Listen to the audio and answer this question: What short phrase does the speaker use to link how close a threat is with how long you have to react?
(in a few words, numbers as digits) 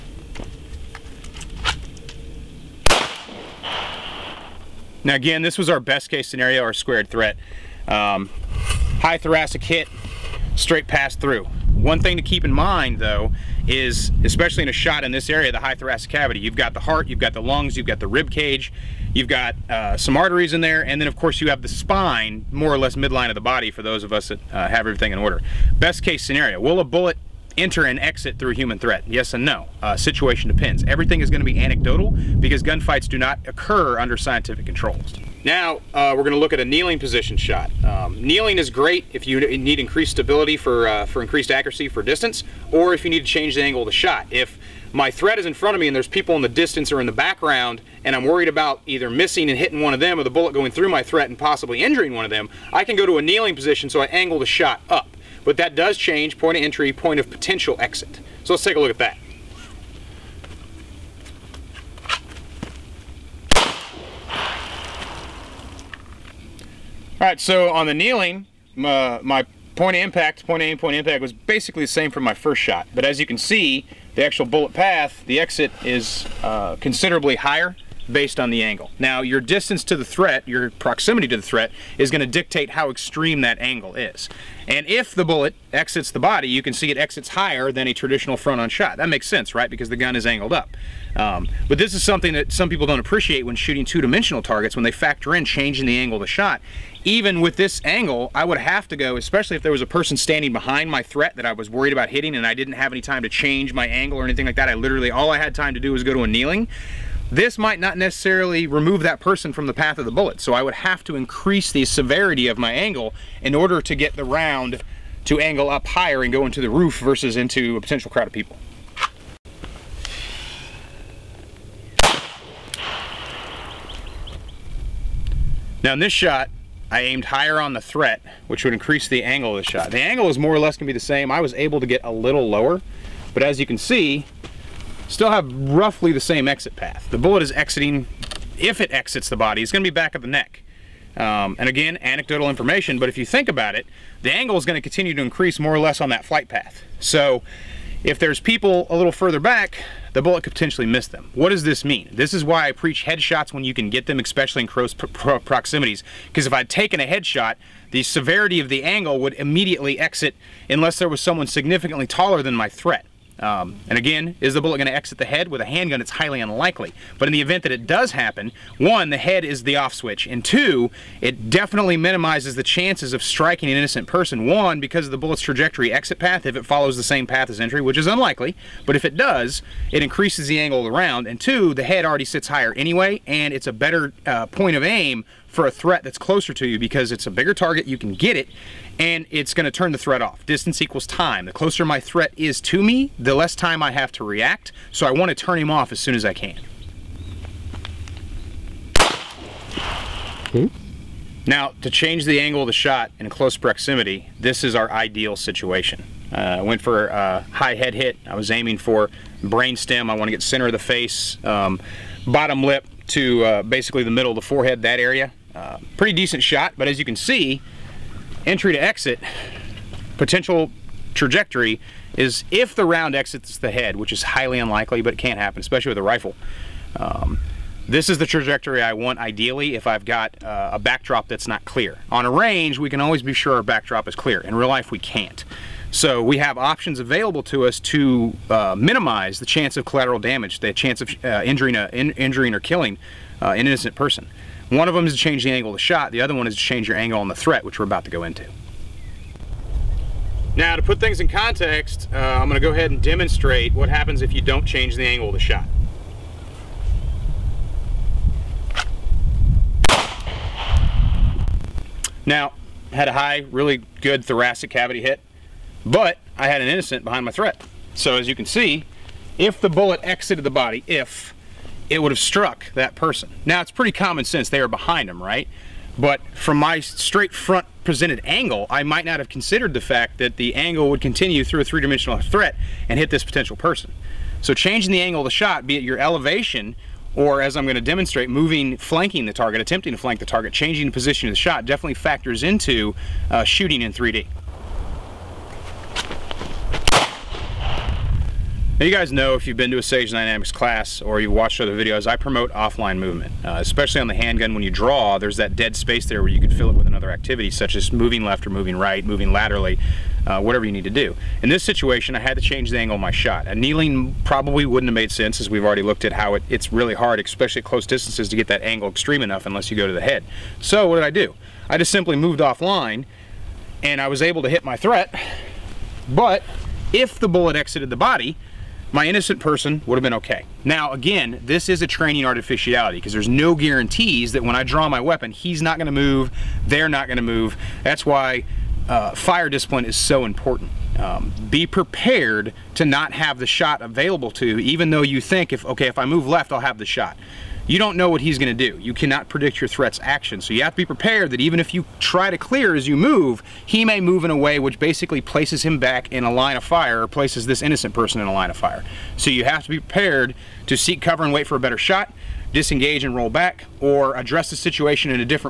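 Distance equals time.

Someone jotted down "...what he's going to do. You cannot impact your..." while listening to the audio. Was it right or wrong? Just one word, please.
wrong.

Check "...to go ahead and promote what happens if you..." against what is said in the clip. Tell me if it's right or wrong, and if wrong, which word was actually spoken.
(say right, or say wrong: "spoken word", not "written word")
wrong: "demonstrate", not "promote".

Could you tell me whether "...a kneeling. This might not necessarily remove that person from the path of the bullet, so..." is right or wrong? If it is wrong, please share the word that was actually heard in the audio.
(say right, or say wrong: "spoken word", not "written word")
right.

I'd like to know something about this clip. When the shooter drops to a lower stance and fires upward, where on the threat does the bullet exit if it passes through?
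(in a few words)
back of the neck.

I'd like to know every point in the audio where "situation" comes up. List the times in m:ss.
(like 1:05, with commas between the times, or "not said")
0:29, 3:25, 5:11, 6:04.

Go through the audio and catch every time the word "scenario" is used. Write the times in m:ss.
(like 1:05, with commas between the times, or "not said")
0:06, 0:26.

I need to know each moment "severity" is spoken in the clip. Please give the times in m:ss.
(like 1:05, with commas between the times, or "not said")
1:51, 2:38.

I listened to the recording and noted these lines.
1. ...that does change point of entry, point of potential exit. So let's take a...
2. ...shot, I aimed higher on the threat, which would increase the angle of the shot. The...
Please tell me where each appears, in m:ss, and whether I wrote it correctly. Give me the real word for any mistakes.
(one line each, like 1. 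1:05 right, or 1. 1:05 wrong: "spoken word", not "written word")
1. 0:55 right
2. 2:06 right.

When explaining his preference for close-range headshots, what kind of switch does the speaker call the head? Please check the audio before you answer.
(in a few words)
the off switch.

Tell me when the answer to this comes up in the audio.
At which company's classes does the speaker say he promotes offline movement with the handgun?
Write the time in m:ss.
4:59.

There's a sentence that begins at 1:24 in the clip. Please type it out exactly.
And if the bullet exits the body, you can see it exits higher than a traditional front on shot.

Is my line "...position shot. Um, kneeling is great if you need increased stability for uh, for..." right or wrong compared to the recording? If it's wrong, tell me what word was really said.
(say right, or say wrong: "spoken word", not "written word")
right.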